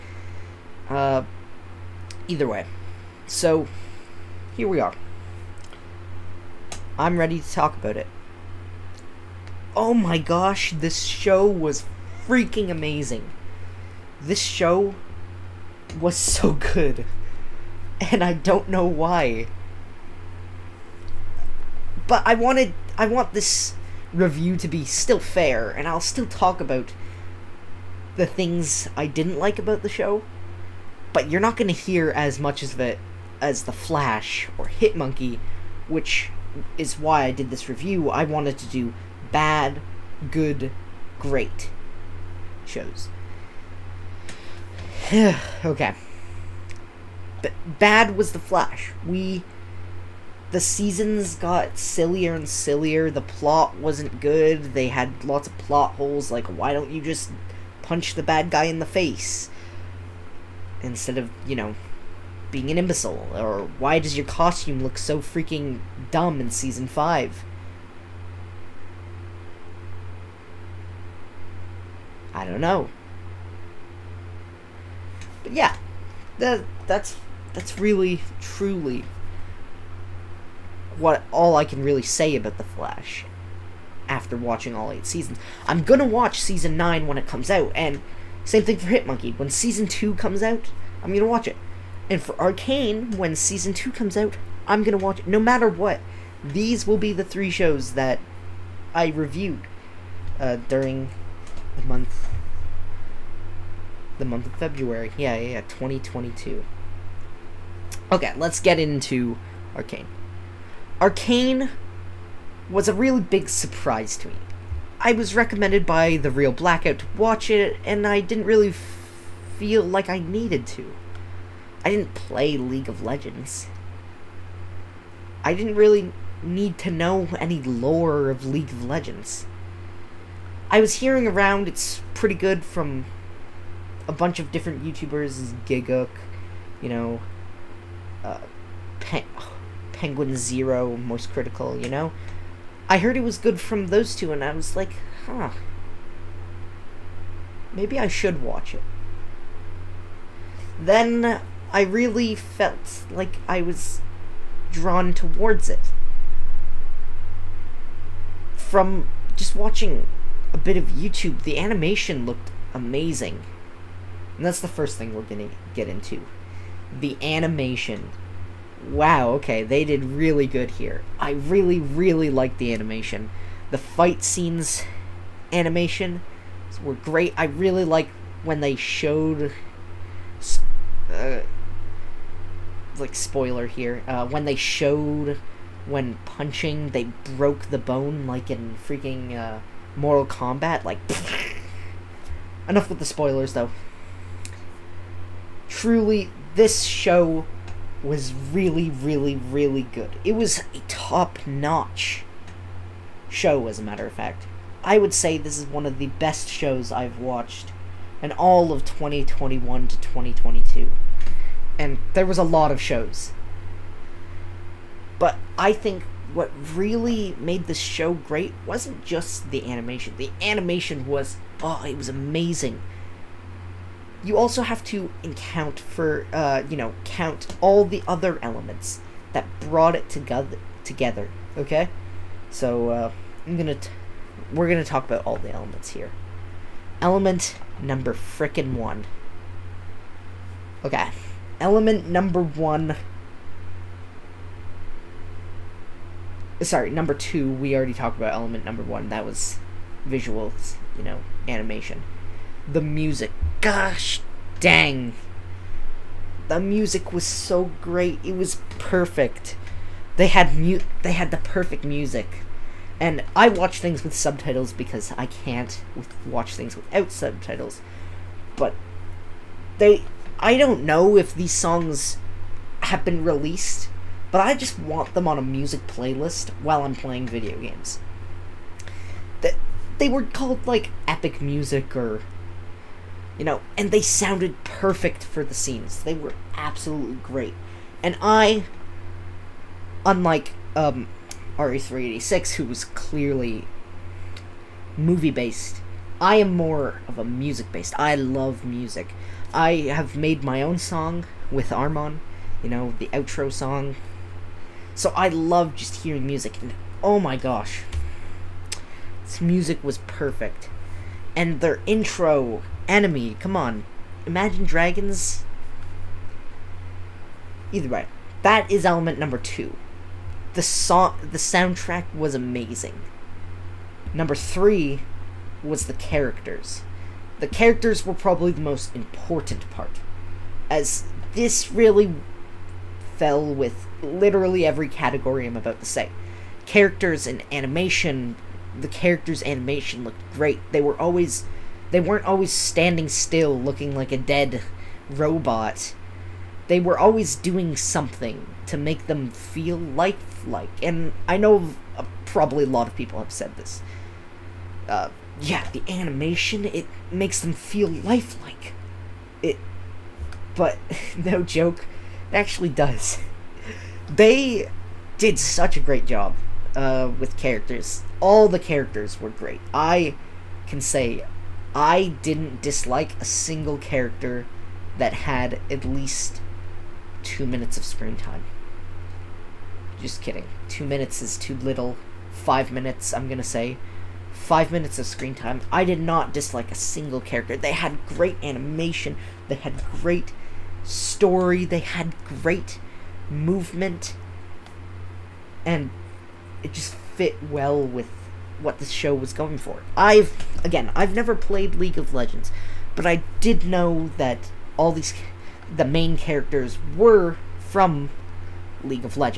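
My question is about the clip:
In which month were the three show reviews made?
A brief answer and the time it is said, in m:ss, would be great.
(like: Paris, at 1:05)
February, at 1:44.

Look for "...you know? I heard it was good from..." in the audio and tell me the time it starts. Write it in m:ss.
2:21.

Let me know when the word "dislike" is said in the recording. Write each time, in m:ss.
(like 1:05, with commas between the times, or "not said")
6:12, 6:26.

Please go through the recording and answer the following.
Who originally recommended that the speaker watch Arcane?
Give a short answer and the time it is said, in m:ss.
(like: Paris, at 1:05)
the real Blackout, at 1:56.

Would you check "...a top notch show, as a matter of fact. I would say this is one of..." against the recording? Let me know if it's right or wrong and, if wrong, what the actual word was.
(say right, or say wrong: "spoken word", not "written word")
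right.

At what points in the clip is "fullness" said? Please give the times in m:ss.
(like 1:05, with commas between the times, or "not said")
not said.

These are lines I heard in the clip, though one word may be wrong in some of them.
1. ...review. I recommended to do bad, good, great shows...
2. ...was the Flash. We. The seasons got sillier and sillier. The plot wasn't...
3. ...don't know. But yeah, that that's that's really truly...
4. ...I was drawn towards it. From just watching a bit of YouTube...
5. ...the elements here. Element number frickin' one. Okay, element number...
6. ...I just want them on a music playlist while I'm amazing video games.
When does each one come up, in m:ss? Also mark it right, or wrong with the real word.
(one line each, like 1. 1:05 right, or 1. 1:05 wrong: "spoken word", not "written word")
1. 0:37 wrong: "wanted", not "recommended"
2. 0:48 right
3. 1:12 right
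4. 2:33 right
5. 3:55 right
6. 4:34 wrong: "playing", not "amazing".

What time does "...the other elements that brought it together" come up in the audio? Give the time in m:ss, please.
3:47.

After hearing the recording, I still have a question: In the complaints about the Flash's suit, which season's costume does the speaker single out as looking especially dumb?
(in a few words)
Season 5.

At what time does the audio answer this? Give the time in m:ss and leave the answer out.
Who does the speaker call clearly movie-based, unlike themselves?
4:51.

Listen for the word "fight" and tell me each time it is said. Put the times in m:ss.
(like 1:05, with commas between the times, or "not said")
2:53.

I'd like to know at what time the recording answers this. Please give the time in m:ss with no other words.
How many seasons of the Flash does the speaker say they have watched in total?
1:24.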